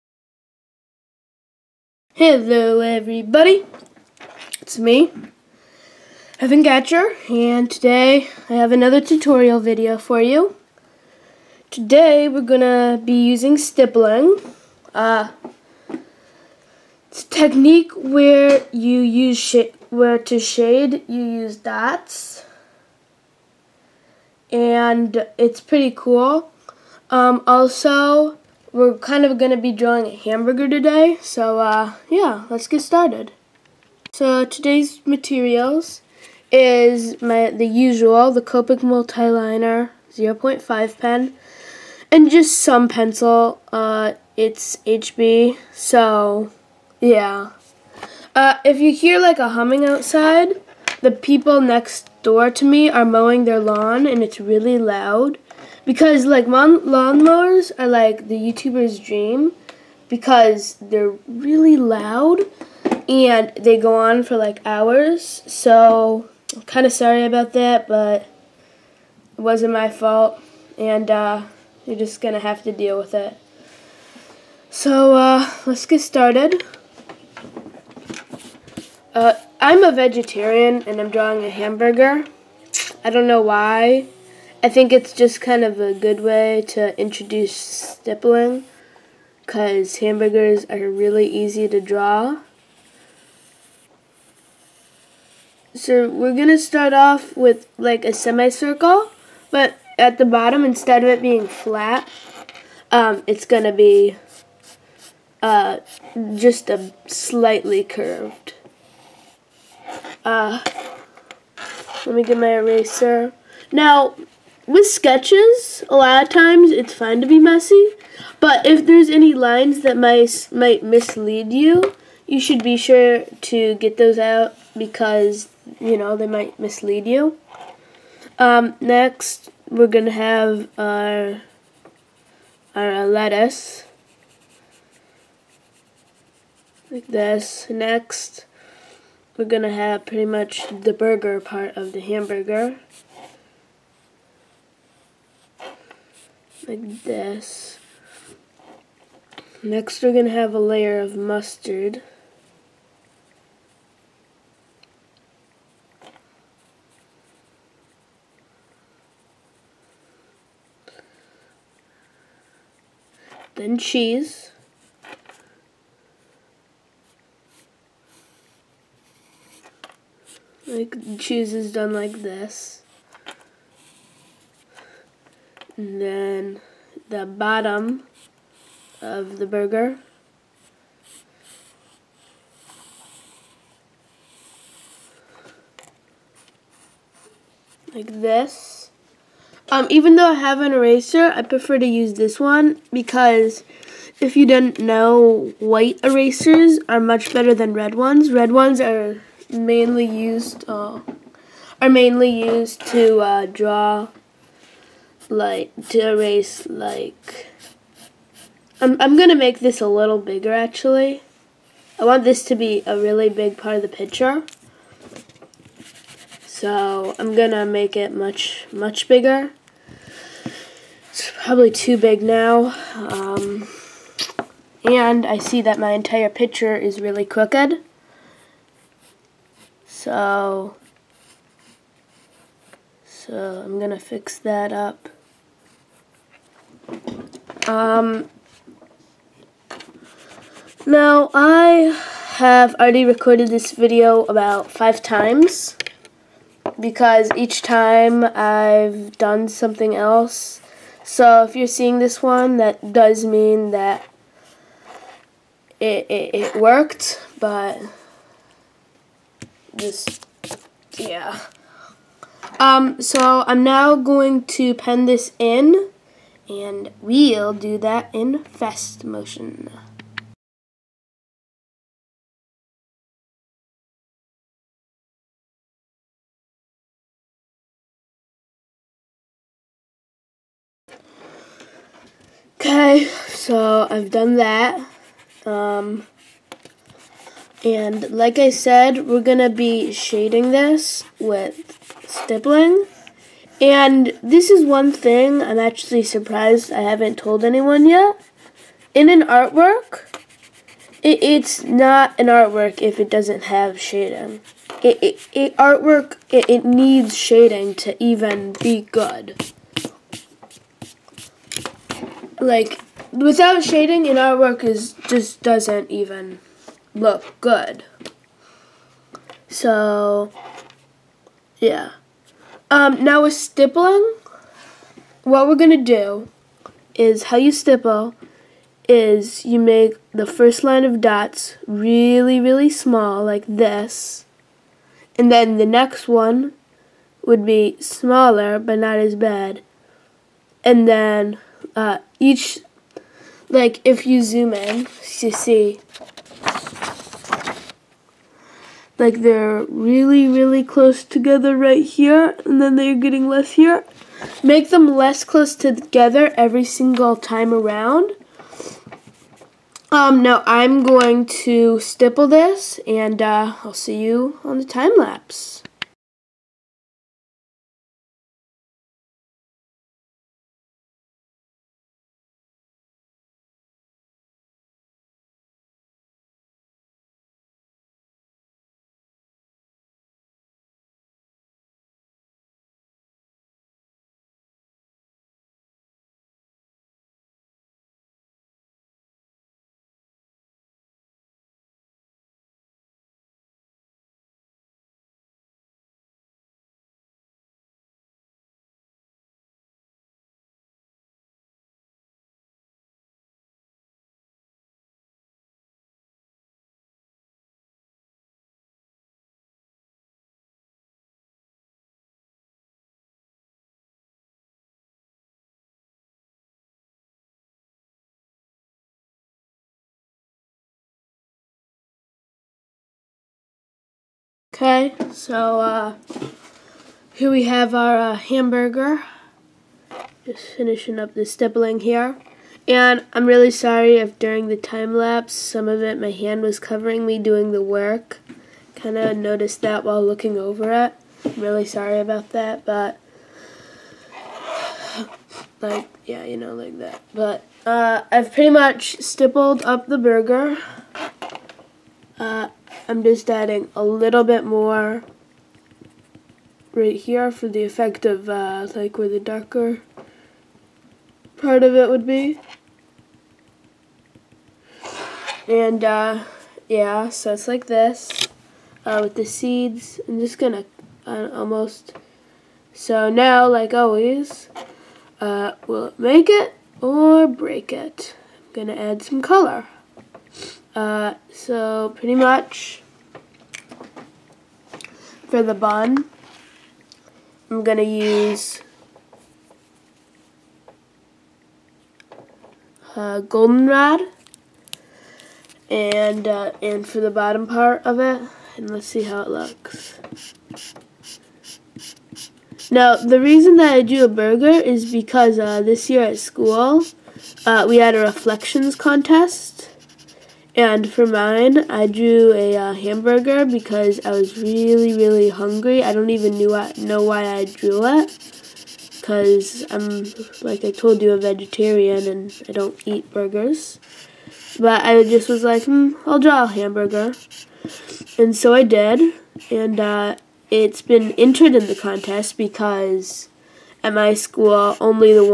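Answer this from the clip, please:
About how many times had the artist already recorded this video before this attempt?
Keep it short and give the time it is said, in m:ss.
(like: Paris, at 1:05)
5, at 4:04.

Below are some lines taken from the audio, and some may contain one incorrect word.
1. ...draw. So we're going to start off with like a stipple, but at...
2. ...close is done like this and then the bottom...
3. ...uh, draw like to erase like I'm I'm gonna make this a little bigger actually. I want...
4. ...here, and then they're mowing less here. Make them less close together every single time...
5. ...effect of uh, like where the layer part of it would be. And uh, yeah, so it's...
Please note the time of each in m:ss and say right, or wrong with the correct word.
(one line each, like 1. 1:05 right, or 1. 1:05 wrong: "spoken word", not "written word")
1. 1:31 wrong: "semicircle", not "stipple"
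2. 2:51 wrong: "cheese", not "close"
3. 3:23 right
4. 5:51 wrong: "getting", not "mowing"
5. 7:37 wrong: "darker", not "layer".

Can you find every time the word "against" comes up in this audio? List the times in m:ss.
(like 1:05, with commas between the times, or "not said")
not said.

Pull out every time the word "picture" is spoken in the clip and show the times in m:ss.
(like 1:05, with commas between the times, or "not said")
3:33, 3:46.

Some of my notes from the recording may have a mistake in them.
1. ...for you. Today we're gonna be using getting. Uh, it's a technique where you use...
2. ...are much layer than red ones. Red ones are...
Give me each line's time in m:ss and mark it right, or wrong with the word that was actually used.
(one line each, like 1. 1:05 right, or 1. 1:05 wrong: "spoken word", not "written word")
1. 0:09 wrong: "stippling", not "getting"
2. 3:16 wrong: "better", not "layer".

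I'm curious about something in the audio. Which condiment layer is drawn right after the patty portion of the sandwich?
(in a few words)
Mustard.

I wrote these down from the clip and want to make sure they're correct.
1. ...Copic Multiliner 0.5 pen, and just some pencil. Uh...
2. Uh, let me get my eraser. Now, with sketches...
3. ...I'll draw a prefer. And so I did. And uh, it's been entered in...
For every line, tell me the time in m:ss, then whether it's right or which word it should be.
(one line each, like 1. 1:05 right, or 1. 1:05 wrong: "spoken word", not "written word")
1. 0:38 right
2. 1:50 right
3. 8:46 wrong: "hamburger", not "prefer".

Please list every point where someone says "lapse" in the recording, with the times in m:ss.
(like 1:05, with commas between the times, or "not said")
6:04, 7:14.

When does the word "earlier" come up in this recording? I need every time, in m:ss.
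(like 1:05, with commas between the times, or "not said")
not said.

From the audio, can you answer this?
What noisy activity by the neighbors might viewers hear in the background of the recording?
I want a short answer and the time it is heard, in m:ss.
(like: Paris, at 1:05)
Mowing their lawn, at 0:53.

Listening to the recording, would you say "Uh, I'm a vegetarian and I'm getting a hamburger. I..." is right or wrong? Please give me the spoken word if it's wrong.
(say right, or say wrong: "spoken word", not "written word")
wrong: "drawing", not "getting".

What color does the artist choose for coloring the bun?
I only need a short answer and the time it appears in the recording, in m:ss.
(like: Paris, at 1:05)
Goldenrod, at 8:13.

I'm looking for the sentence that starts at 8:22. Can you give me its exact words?
Now, the reason that I do a burger is because uh, this year at school, uh, we had a reflections contest.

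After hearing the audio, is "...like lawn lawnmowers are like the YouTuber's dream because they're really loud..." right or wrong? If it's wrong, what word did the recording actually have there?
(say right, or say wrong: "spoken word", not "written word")
right.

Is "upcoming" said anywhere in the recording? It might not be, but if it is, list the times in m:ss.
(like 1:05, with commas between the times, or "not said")
not said.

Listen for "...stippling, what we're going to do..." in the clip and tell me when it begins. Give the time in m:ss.
5:23.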